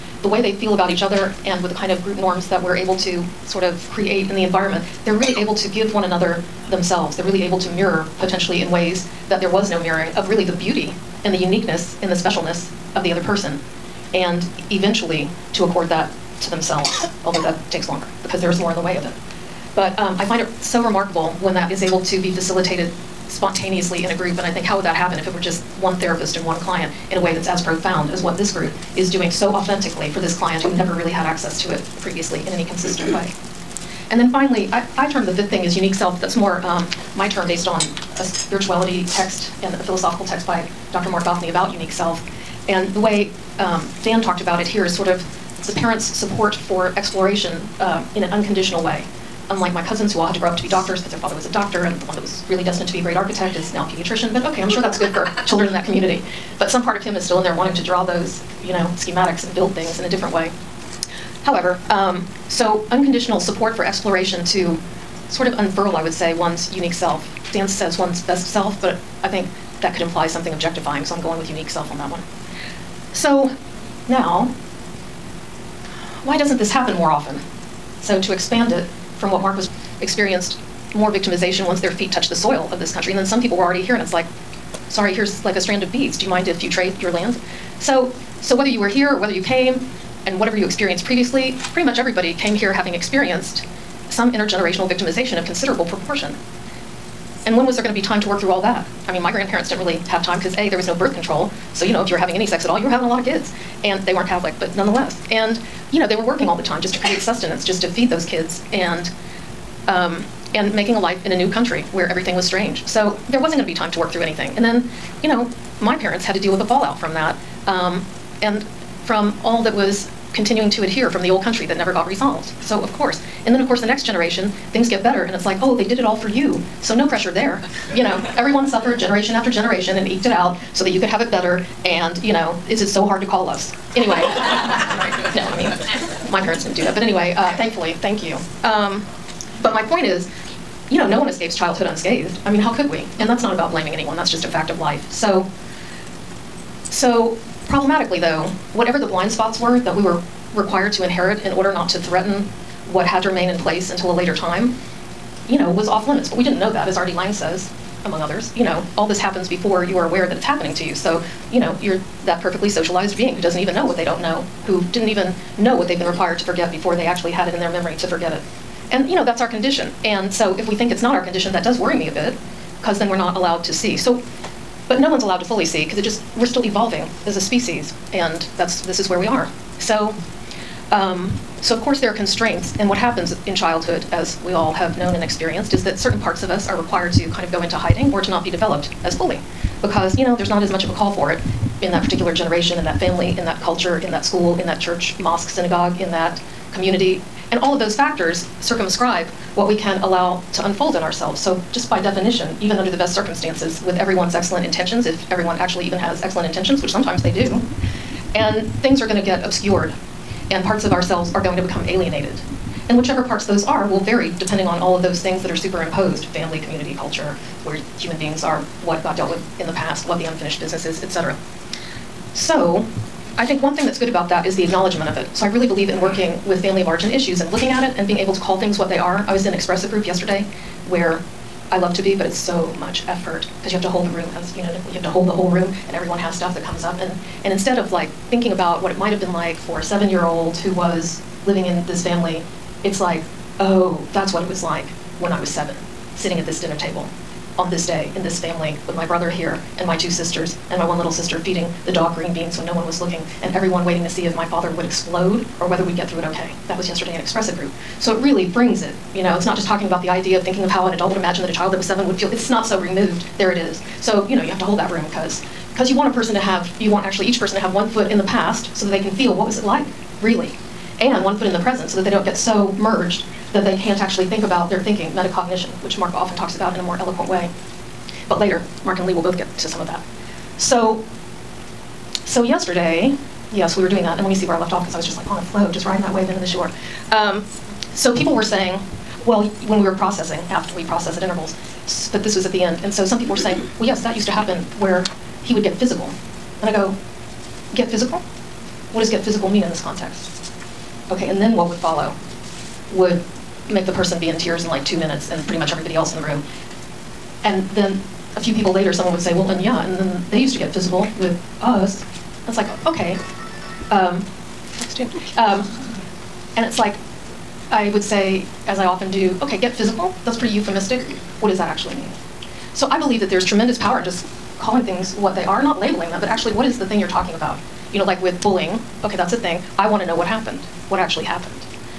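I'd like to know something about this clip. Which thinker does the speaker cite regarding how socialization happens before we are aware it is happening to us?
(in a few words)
R.D. Laing.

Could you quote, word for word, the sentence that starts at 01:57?
Um, and from all that was continuing to adhere from the old country that never got resolved.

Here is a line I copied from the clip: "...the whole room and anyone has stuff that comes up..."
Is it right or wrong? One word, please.
wrong.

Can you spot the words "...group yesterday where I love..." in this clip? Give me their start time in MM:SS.
03:49.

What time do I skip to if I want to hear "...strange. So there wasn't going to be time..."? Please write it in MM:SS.
01:52.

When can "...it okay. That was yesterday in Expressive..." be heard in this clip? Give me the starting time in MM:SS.
04:16.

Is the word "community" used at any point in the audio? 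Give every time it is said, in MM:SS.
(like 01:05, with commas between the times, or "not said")
00:55, 03:16, 03:36.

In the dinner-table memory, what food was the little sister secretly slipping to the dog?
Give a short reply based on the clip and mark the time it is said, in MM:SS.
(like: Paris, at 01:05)
Green beans, at 04:12.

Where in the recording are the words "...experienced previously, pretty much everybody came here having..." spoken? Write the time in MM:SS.
01:30.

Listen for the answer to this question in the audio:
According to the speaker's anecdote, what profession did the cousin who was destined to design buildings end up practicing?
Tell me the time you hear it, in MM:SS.
00:53.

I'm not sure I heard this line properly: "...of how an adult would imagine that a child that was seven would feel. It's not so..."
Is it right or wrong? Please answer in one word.
right.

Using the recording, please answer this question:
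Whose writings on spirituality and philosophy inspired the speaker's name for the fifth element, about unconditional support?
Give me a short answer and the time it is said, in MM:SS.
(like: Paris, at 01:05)
Dr. Marc Gafni, at 00:40.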